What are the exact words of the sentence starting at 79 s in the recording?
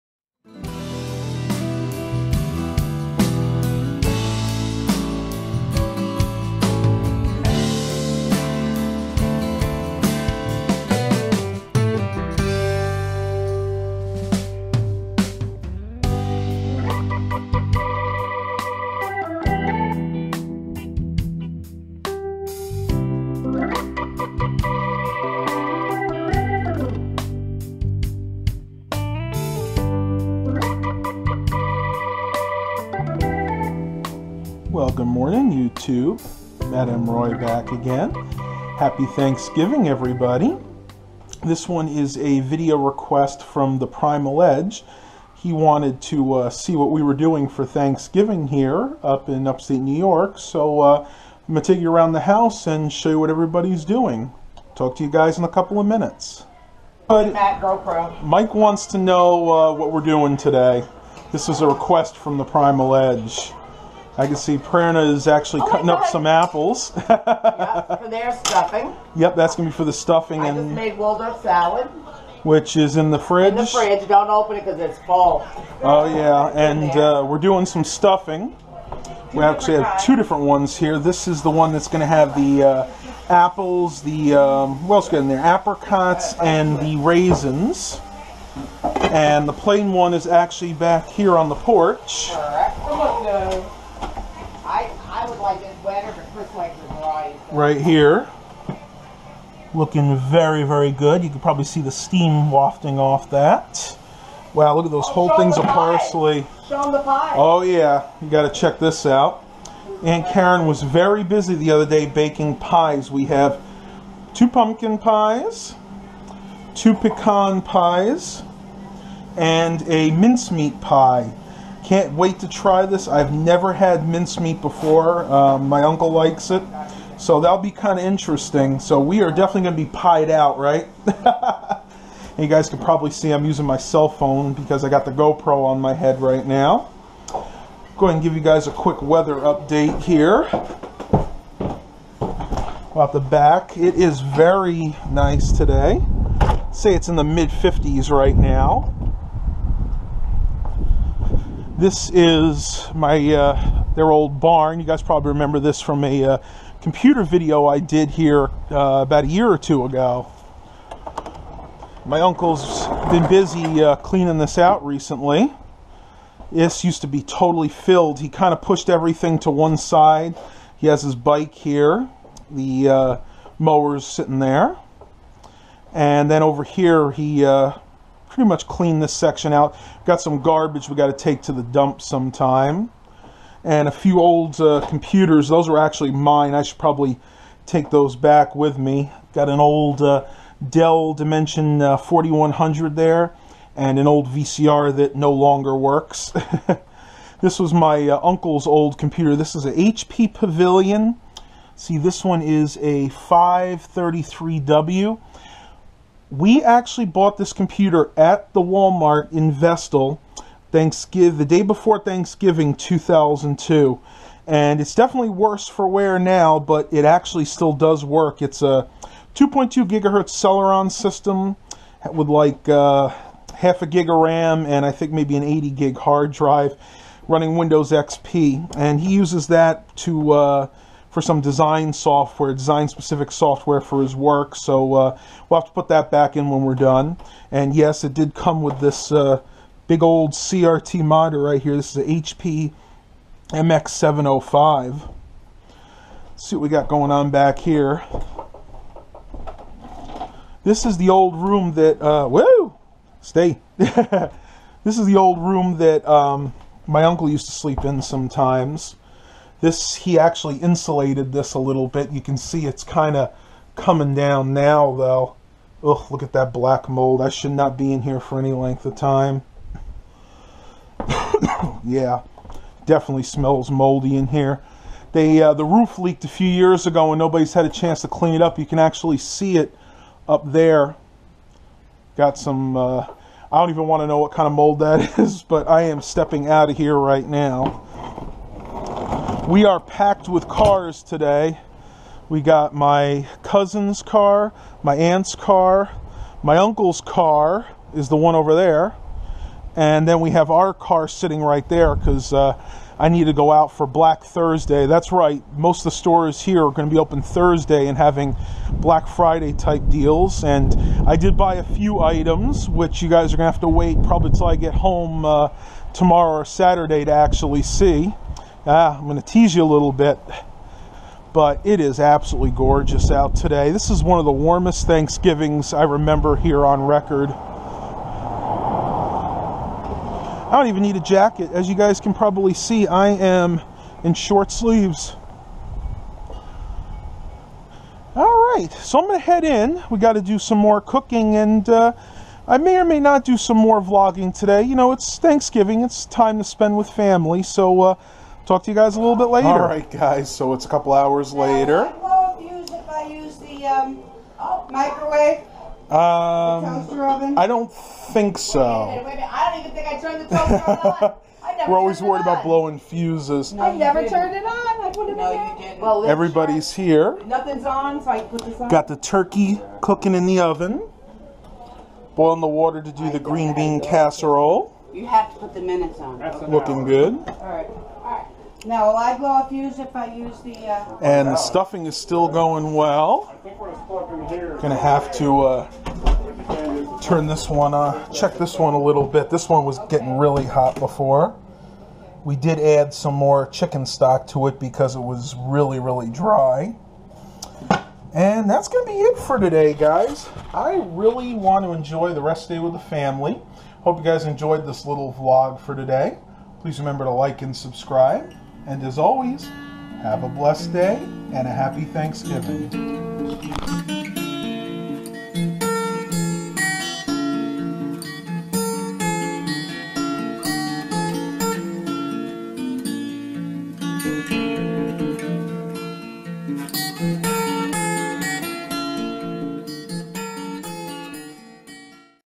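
Two we actually have two different ones here.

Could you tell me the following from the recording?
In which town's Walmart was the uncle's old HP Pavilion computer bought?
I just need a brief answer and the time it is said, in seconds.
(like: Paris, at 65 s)
Vestal, at 209 s.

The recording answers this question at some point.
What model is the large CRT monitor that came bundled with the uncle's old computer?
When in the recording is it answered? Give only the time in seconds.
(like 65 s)
242 s.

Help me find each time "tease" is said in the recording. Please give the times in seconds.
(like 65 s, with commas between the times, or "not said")
319 s.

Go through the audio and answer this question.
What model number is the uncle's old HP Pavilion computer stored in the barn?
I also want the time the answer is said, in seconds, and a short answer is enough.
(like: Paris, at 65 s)
533W, at 203 s.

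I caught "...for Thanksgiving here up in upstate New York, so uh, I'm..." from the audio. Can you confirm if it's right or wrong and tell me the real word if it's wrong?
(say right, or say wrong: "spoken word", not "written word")
right.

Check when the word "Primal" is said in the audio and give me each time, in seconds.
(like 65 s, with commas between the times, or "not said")
43 s, 62 s.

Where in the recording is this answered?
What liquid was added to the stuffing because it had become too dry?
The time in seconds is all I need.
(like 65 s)
393 s.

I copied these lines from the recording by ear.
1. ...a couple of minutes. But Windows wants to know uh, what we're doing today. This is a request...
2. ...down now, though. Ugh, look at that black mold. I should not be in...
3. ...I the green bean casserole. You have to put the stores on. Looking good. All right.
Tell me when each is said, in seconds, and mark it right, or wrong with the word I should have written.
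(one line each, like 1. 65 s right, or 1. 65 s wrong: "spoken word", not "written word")
1. 55 s wrong: "Mike", not "Windows"
2. 264 s right
3. 373 s wrong: "minutes", not "stores".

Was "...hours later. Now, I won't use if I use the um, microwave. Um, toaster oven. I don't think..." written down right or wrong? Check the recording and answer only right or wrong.
right.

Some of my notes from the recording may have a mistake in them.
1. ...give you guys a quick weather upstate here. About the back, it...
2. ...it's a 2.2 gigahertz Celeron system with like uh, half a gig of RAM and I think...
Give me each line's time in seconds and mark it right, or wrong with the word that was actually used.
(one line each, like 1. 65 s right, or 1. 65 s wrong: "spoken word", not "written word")
1. 138 s wrong: "update", not "upstate"
2. 218 s right.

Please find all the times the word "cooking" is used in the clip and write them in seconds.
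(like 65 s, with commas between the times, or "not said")
340 s, 369 s.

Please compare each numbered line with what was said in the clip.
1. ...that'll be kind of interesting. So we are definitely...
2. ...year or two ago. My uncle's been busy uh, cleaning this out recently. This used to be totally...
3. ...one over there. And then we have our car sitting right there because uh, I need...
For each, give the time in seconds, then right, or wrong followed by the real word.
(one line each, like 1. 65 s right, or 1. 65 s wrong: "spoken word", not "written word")
1. 127 s right
2. 159 s right
3. 298 s right.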